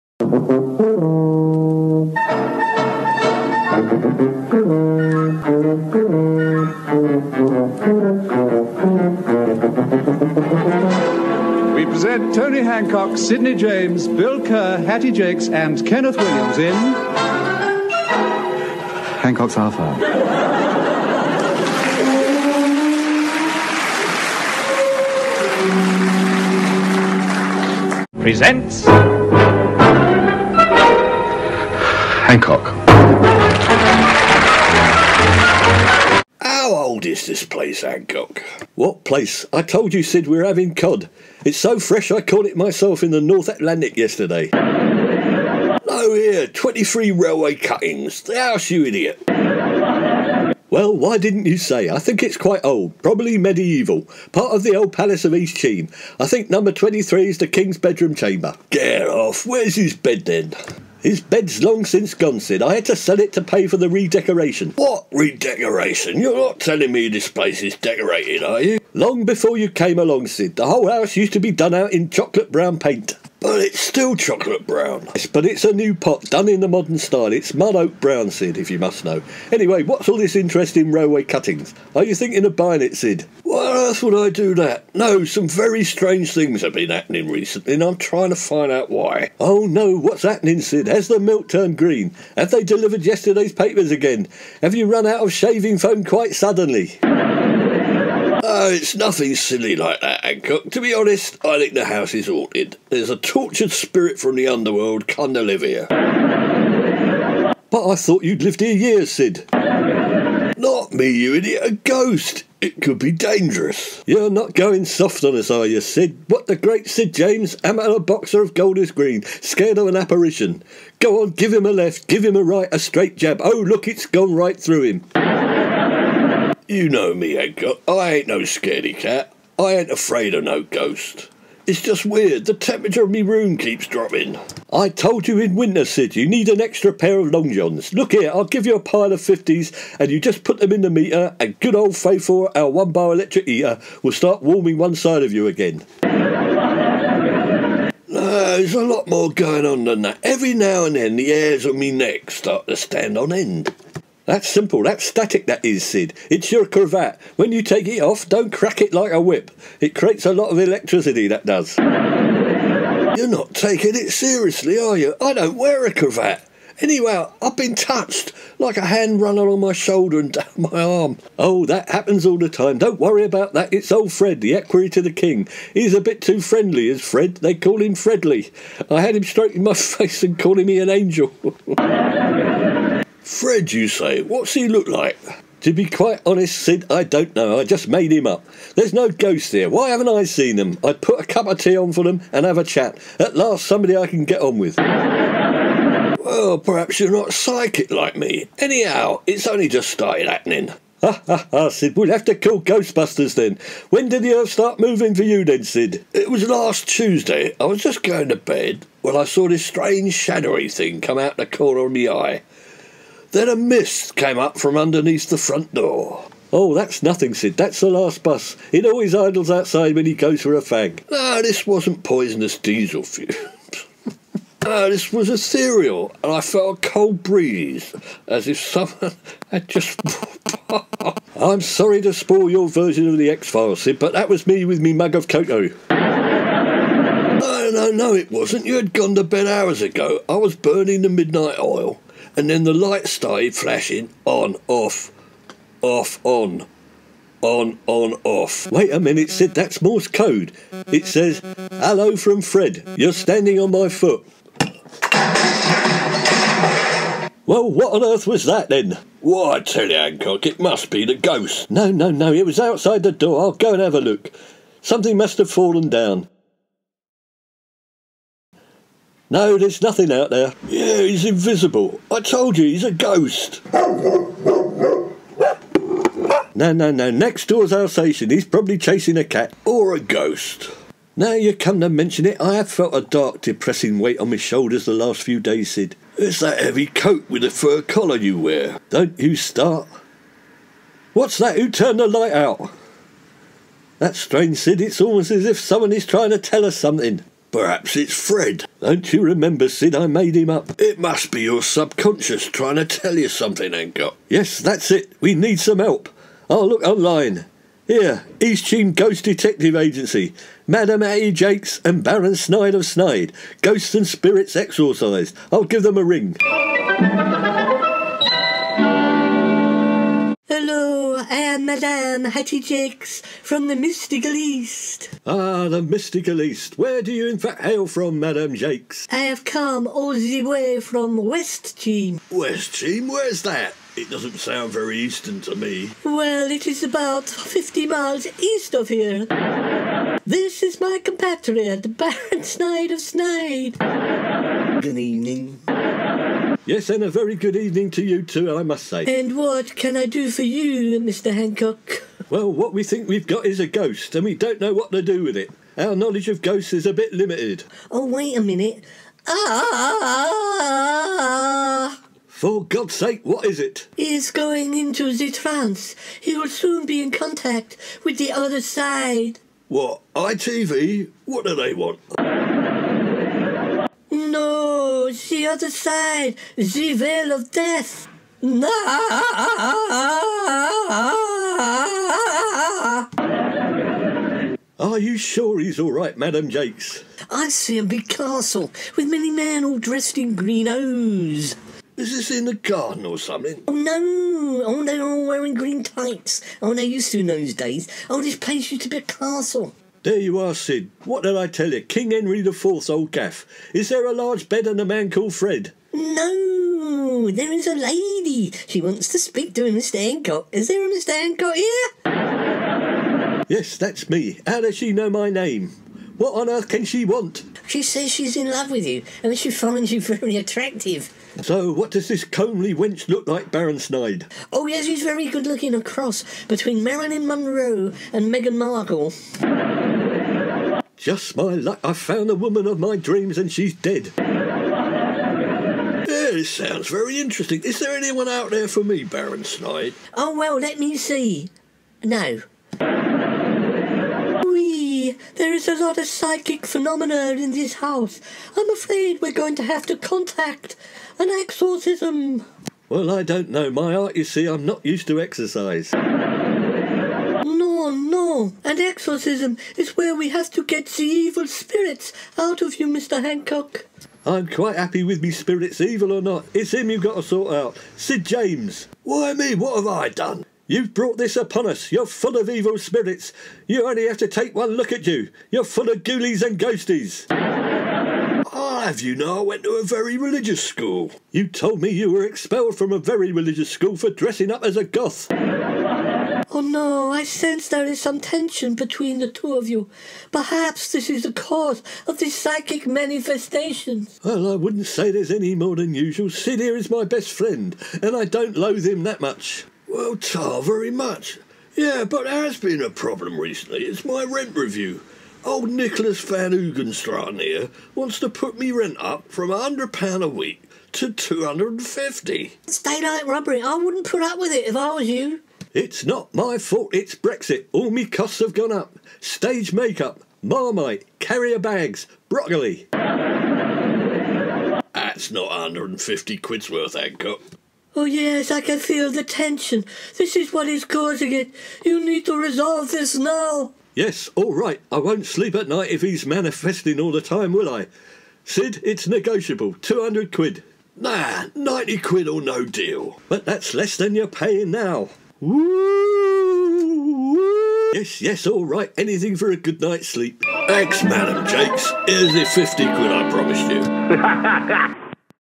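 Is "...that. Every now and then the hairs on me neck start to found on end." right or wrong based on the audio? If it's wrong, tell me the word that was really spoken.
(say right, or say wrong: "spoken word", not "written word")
wrong: "stand", not "found".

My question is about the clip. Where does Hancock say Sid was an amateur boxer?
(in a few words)
Golders Green.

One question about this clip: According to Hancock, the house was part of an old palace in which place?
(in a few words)
East Sheen.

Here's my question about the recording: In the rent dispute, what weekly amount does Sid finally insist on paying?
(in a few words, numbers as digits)
£90.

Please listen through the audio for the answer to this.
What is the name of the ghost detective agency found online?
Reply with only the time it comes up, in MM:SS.
05:08.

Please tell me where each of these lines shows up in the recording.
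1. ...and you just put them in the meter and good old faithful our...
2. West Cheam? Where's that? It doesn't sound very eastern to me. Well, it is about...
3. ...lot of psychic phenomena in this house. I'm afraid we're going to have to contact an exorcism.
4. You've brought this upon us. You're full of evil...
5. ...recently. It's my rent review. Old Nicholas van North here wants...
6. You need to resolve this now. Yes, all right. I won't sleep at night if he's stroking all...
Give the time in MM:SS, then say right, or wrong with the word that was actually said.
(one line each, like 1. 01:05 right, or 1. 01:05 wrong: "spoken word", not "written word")
1. 02:19 right
2. 05:32 right
3. 07:25 right
4. 07:50 right
5. 08:23 wrong: "Hoogstraten", not "North"
6. 08:51 wrong: "manifesting", not "stroking".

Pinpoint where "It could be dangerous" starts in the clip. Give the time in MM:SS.
01:52.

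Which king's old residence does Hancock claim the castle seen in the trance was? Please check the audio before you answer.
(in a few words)
King Henry IV.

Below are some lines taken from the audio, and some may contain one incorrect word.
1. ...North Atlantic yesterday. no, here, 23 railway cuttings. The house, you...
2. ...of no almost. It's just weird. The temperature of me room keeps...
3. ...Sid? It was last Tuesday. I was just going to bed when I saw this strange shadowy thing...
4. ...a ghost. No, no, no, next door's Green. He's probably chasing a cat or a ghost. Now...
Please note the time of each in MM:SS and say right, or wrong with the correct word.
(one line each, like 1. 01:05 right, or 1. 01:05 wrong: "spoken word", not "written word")
1. 00:43 right
2. 02:10 wrong: "ghost", not "almost"
3. 03:25 right
4. 04:32 wrong: "Alsatian", not "Green".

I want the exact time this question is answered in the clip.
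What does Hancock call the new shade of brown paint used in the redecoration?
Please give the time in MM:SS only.
01:17.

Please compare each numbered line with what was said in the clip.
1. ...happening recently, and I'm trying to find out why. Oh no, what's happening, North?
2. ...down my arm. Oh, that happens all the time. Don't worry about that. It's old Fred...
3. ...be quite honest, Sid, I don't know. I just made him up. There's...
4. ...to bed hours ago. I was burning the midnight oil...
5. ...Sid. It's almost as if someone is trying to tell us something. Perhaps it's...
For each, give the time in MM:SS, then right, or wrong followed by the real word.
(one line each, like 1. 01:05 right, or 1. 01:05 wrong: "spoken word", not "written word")
1. 01:26 wrong: "Sid", not "North"
2. 02:50 right
3. 03:05 right
4. 03:59 right
5. 04:54 right.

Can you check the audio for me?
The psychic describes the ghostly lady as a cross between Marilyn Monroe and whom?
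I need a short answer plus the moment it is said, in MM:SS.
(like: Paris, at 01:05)
Meghan Markle, at 07:08.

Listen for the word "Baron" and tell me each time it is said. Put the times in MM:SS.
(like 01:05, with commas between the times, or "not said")
05:12, 05:41, 07:03, 07:19.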